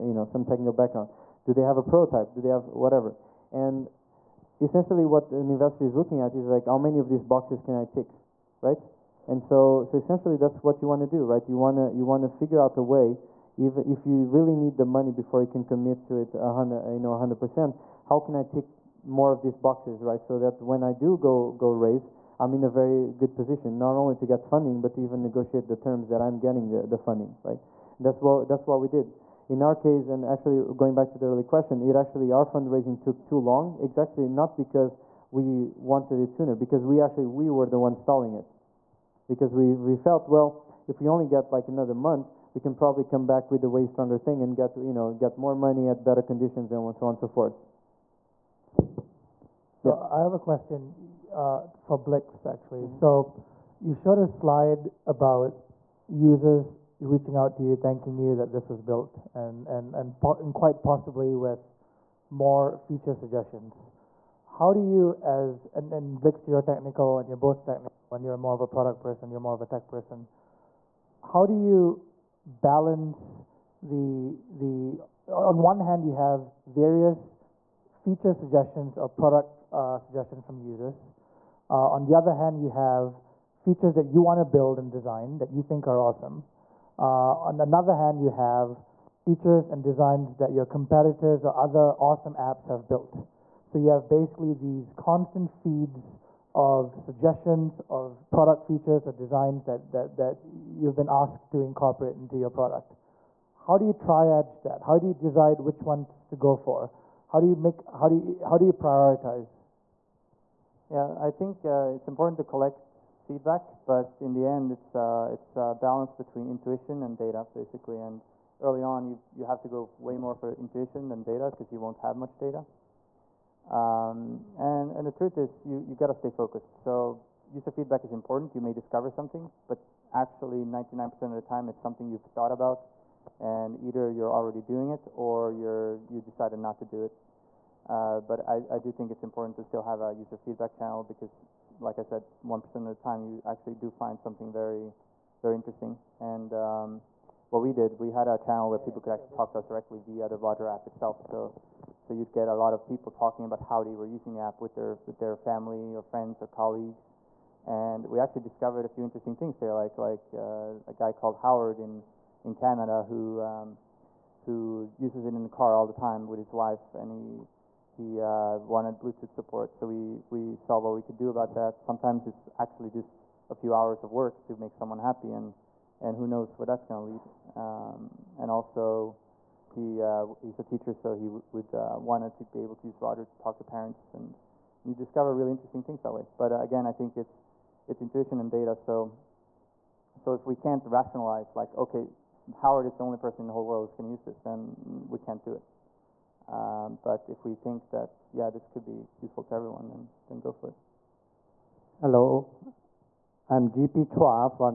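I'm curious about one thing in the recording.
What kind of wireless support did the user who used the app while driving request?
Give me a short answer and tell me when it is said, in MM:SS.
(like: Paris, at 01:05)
Bluetooth, at 02:48.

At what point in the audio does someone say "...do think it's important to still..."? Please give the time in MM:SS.
02:18.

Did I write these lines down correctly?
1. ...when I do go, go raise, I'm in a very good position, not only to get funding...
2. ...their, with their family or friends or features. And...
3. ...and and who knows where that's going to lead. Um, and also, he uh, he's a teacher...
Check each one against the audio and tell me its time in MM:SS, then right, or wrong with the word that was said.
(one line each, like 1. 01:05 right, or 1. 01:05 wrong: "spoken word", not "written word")
1. 00:20 right
2. 02:34 wrong: "colleagues", not "features"
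3. 02:55 right.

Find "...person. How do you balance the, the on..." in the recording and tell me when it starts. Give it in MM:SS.
01:09.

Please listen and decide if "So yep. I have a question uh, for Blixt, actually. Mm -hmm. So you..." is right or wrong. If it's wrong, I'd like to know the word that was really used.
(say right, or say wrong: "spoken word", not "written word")
right.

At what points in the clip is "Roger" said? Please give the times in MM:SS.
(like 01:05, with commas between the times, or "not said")
02:30, 03:03.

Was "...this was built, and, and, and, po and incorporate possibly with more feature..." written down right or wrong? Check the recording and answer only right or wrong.
wrong.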